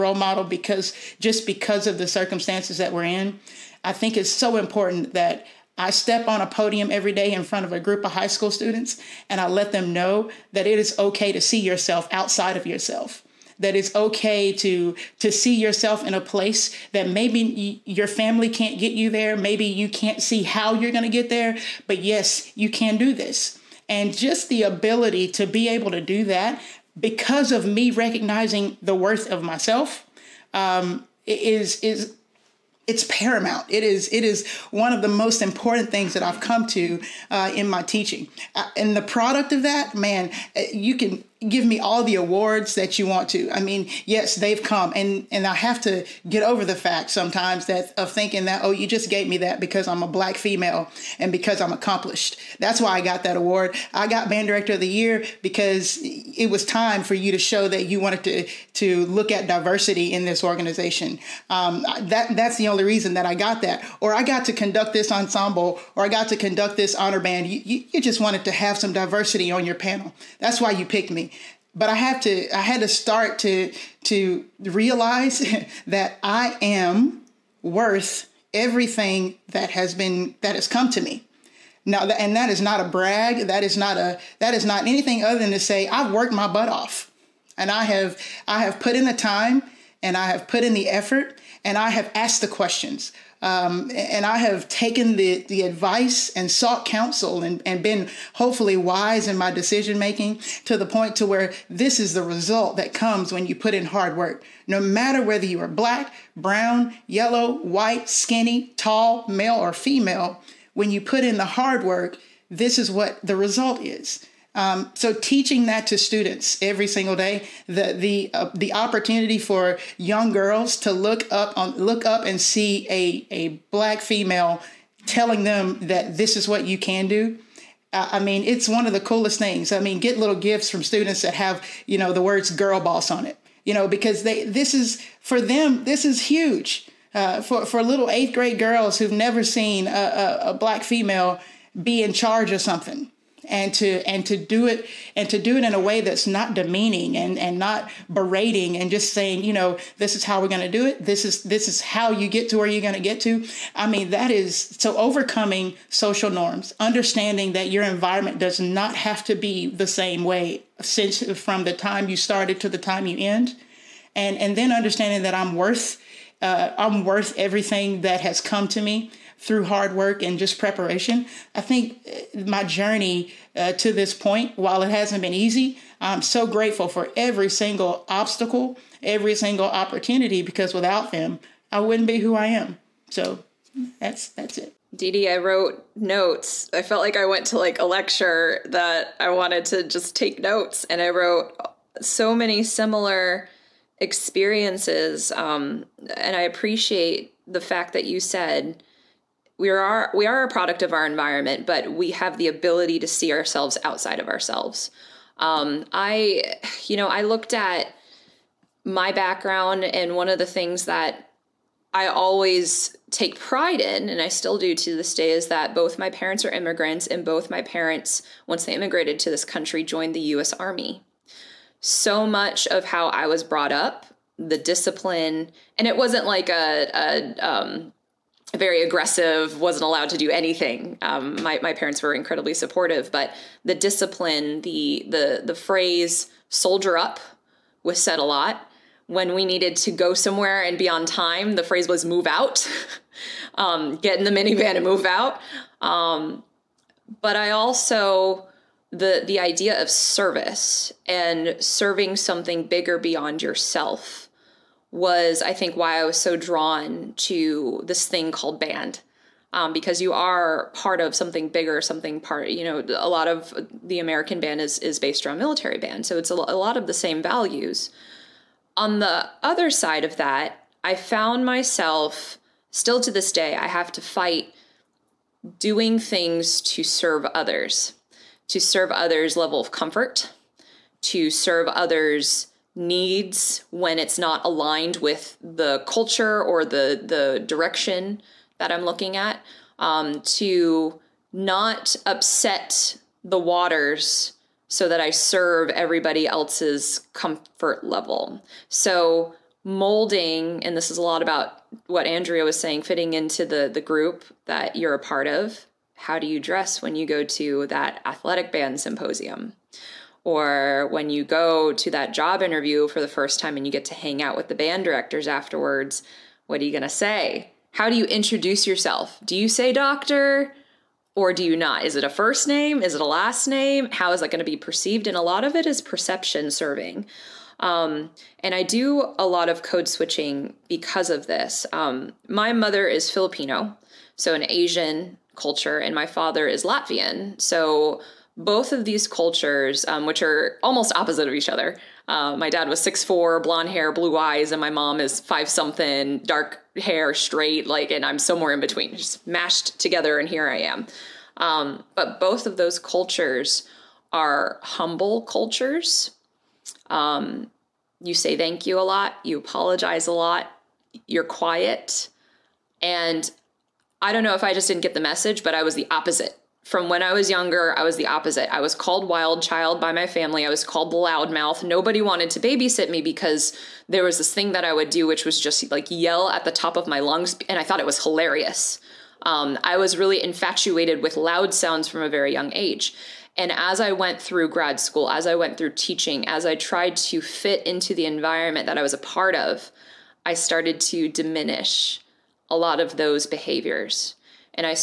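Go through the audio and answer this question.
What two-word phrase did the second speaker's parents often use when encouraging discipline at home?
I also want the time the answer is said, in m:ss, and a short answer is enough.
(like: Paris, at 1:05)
soldier up, at 3:56.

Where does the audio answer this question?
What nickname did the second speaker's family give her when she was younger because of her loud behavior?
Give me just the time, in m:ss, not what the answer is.
6:09.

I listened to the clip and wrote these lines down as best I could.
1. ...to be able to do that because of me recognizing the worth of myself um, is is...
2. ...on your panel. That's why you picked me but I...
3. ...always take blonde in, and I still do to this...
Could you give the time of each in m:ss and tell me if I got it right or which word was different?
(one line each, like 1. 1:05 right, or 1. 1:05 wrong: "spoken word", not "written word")
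1. 0:25 right
2. 1:09 right
3. 3:32 wrong: "pride", not "blonde".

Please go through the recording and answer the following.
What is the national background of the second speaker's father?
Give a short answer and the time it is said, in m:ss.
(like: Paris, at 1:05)
Latvian, at 5:36.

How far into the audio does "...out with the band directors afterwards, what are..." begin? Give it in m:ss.
5:14.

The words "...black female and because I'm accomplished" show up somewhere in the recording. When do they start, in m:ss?
0:50.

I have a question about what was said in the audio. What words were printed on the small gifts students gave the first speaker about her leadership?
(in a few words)
girl boss.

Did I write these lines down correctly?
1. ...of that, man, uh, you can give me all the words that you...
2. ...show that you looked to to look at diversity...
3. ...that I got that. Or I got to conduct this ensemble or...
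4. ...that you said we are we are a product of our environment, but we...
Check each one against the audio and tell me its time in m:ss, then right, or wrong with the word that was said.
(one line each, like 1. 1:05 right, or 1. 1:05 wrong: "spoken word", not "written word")
1. 0:39 wrong: "awards", not "words"
2. 0:57 wrong: "wanted", not "looked"
3. 1:03 right
4. 3:17 right.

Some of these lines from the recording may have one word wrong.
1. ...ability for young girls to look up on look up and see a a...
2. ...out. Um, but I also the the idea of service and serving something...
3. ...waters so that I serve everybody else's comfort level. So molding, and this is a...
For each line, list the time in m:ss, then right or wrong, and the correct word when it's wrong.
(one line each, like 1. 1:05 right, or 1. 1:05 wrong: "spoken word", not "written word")
1. 1:58 wrong: "opportunity", not "ability"
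2. 4:05 right
3. 4:53 right.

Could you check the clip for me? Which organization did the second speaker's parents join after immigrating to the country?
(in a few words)
U.S. Army.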